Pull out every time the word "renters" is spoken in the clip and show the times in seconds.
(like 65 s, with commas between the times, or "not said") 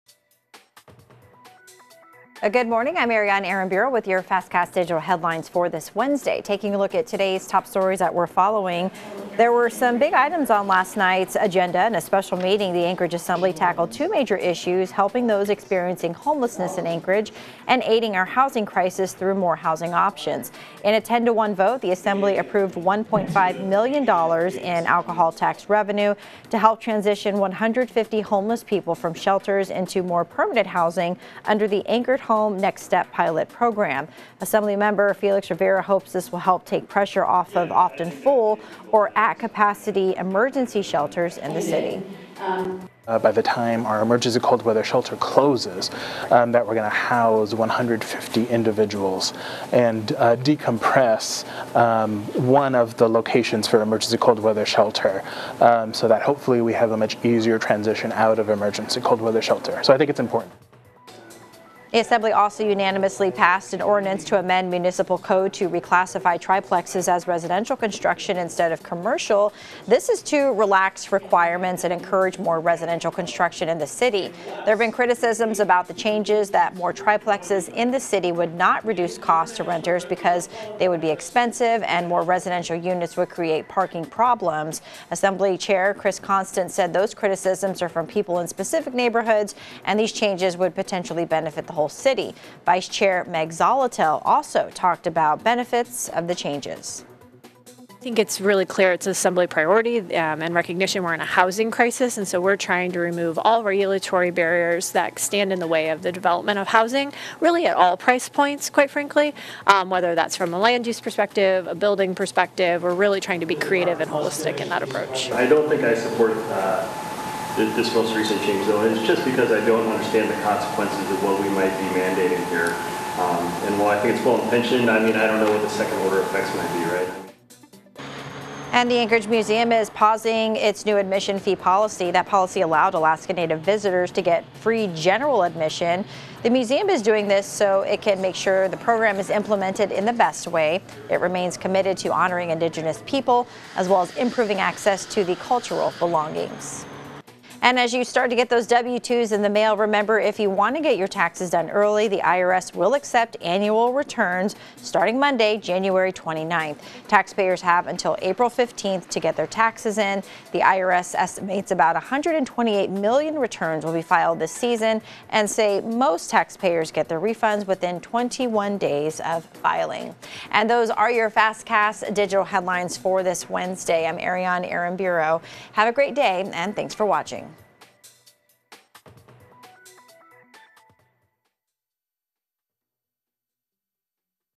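79 s.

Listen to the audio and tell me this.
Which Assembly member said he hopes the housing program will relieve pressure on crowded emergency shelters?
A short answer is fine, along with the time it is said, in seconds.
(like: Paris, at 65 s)
Felix Rivera, at 35 s.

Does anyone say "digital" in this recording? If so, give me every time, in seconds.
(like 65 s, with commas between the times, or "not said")
4 s, 172 s.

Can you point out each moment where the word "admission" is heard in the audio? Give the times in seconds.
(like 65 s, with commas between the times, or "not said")
130 s, 135 s.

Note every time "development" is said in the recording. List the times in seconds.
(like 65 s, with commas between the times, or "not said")
106 s.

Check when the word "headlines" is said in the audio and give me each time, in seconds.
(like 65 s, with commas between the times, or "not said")
4 s, 172 s.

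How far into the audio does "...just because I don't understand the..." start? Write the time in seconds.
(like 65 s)
119 s.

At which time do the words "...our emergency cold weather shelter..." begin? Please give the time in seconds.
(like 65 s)
43 s.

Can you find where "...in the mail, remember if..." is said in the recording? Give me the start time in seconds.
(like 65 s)
149 s.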